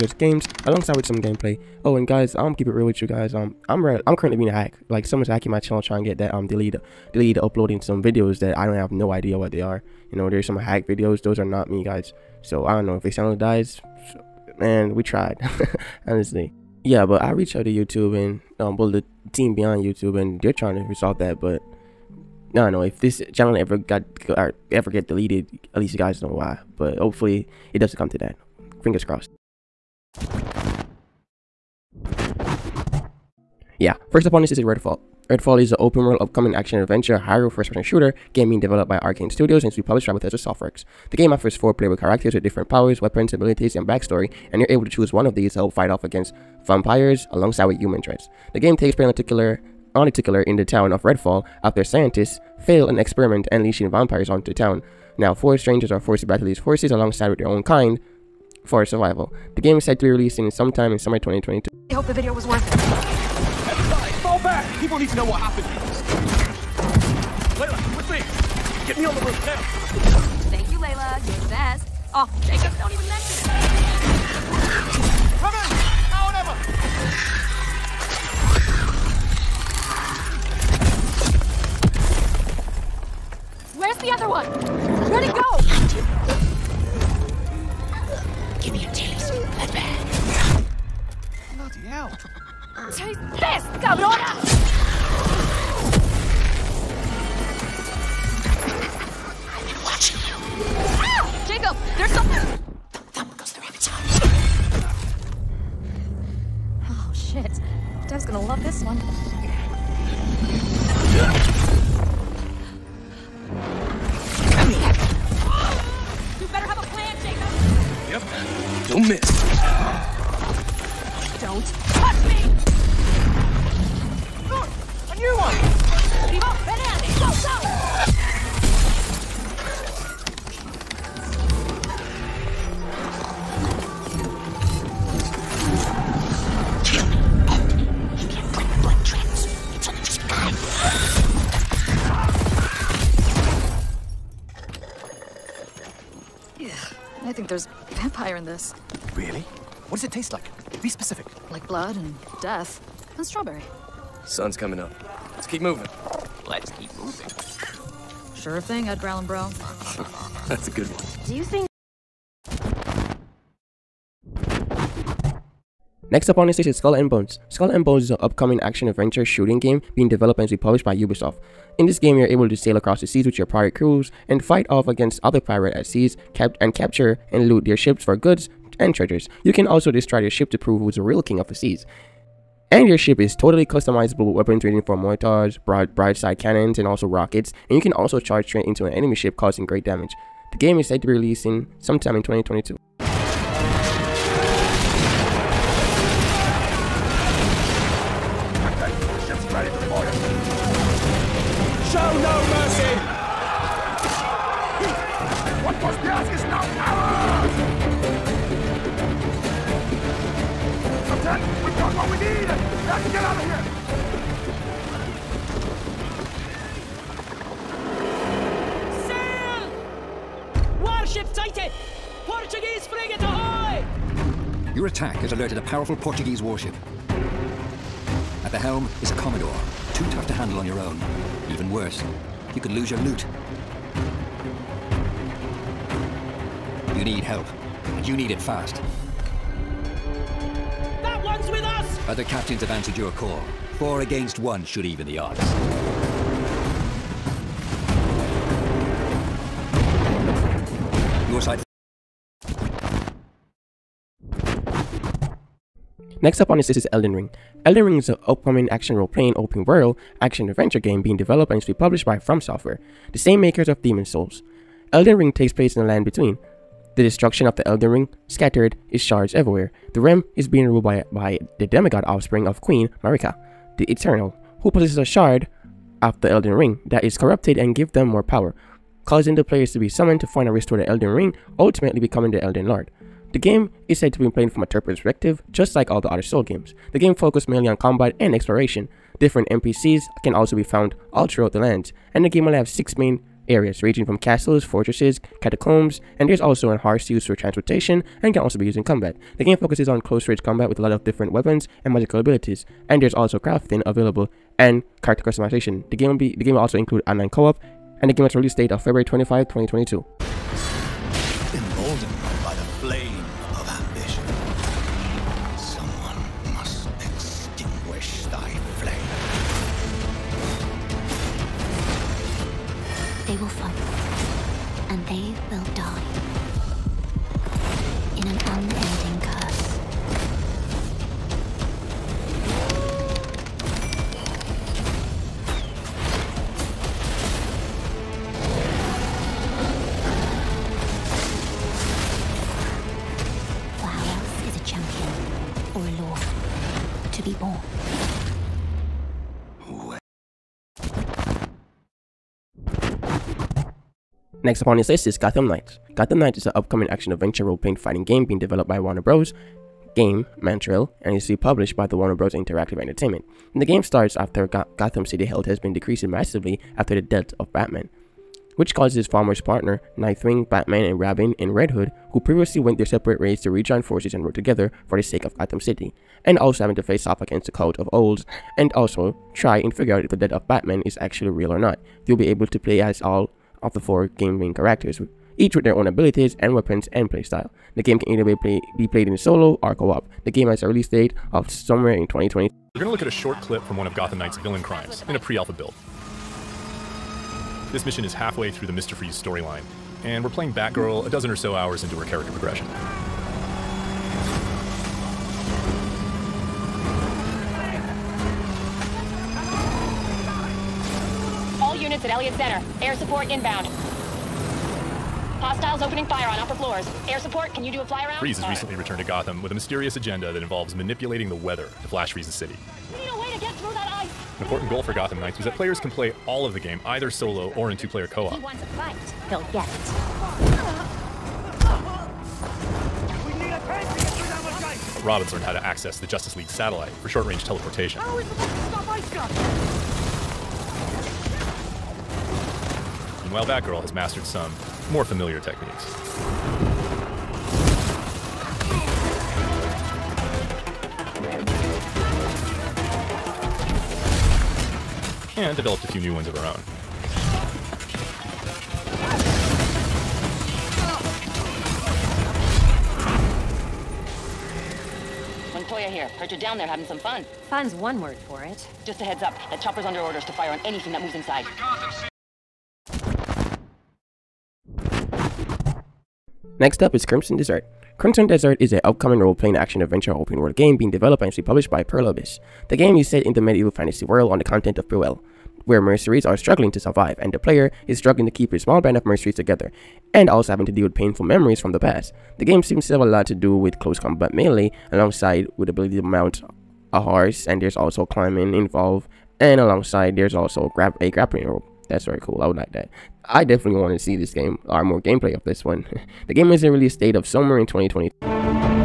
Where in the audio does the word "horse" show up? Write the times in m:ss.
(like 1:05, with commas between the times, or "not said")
4:56, 8:16.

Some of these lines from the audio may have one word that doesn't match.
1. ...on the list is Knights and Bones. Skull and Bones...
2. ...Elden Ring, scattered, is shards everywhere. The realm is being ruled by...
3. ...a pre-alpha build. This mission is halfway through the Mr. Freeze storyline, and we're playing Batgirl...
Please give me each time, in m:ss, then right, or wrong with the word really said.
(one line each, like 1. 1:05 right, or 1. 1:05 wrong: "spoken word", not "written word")
1. 2:46 wrong: "Skull", not "Knights"
2. 4:27 right
3. 6:35 right.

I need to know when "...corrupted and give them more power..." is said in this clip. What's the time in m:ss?
4:37.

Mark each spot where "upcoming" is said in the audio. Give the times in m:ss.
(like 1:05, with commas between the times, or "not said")
0:36, 2:48, 4:18, 5:56, 7:58.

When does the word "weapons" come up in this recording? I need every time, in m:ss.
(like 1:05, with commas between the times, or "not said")
0:42, 3:04, 5:01, 6:26.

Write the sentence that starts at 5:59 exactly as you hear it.
Game, Montreal, and is published by the Warner Bros.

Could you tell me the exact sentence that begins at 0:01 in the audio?
Oh, and guys, I'm keep it real with you guys.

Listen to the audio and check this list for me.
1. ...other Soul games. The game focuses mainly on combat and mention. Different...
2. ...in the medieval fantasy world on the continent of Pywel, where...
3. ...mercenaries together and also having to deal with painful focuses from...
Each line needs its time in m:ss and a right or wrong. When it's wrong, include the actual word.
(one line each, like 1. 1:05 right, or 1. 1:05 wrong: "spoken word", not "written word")
1. 4:46 wrong: "exploration", not "mention"
2. 8:03 right
3. 8:09 wrong: "memories", not "focuses".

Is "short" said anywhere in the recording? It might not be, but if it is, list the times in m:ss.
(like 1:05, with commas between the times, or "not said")
6:33, 7:17.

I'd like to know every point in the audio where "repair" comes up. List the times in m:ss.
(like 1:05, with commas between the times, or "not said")
not said.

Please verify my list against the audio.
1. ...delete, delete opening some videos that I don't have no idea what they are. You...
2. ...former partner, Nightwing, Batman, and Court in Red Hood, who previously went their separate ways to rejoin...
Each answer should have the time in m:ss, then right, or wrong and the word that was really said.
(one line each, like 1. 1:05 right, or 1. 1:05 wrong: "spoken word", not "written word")
1. 0:06 wrong: "uploading", not "opening"
2. 6:09 wrong: "Robin", not "Court".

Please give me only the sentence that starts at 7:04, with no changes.
An important goal for Gotham Knights was that players can play all of the game either solo or in two-player co-op.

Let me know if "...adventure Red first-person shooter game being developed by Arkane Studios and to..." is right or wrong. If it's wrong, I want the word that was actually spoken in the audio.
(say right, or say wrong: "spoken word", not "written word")
wrong: "Hyrule", not "Red".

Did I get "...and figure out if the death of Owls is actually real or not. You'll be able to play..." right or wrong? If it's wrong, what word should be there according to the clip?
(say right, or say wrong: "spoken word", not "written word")
wrong: "Batman", not "Owls".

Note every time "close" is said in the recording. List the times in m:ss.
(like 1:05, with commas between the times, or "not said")
5:00, 8:13.